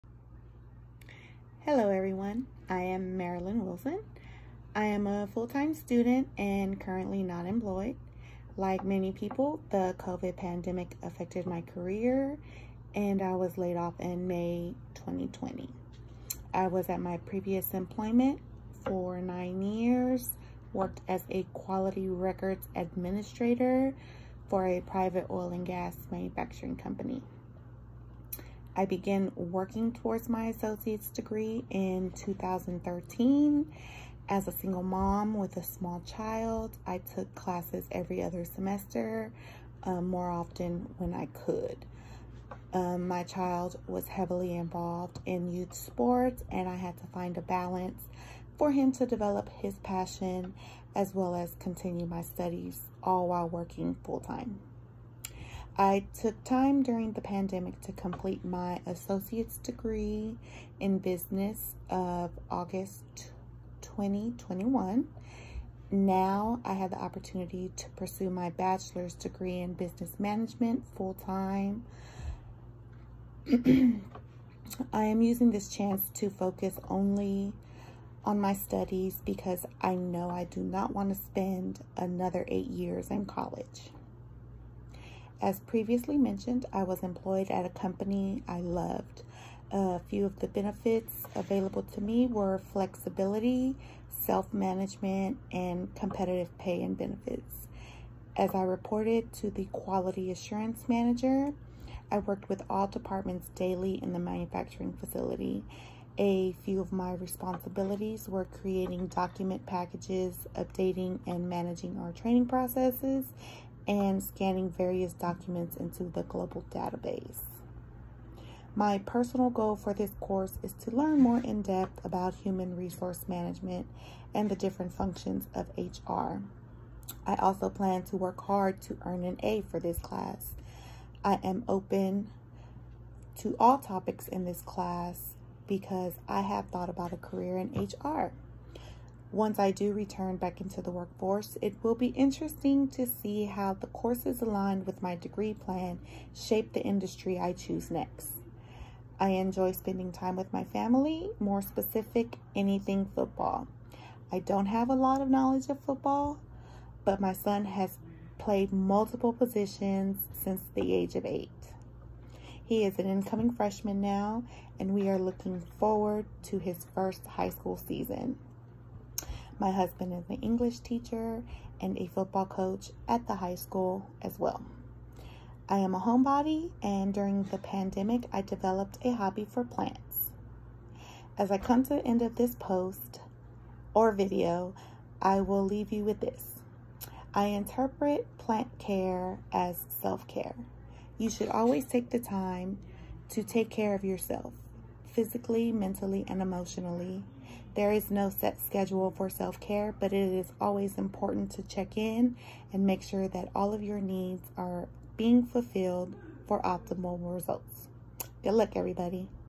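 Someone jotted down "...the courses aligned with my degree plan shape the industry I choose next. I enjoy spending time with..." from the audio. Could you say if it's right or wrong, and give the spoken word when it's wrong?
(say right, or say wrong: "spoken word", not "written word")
right.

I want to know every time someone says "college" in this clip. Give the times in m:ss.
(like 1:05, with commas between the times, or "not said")
1:23.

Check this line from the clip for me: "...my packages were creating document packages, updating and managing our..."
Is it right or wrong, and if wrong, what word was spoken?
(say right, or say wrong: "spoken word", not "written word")
wrong: "responsibilities", not "packages".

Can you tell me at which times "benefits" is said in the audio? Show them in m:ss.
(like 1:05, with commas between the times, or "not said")
1:30, 1:36.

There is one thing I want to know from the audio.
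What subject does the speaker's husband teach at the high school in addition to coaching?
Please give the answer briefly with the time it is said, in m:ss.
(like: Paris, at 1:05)
English, at 2:50.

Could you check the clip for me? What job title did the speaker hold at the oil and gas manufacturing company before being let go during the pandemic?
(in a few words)
quality records administrator.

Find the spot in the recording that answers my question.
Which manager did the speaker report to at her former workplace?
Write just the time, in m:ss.
1:39.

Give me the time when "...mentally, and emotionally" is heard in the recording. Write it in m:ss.
3:15.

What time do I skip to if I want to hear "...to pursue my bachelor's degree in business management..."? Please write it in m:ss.
1:07.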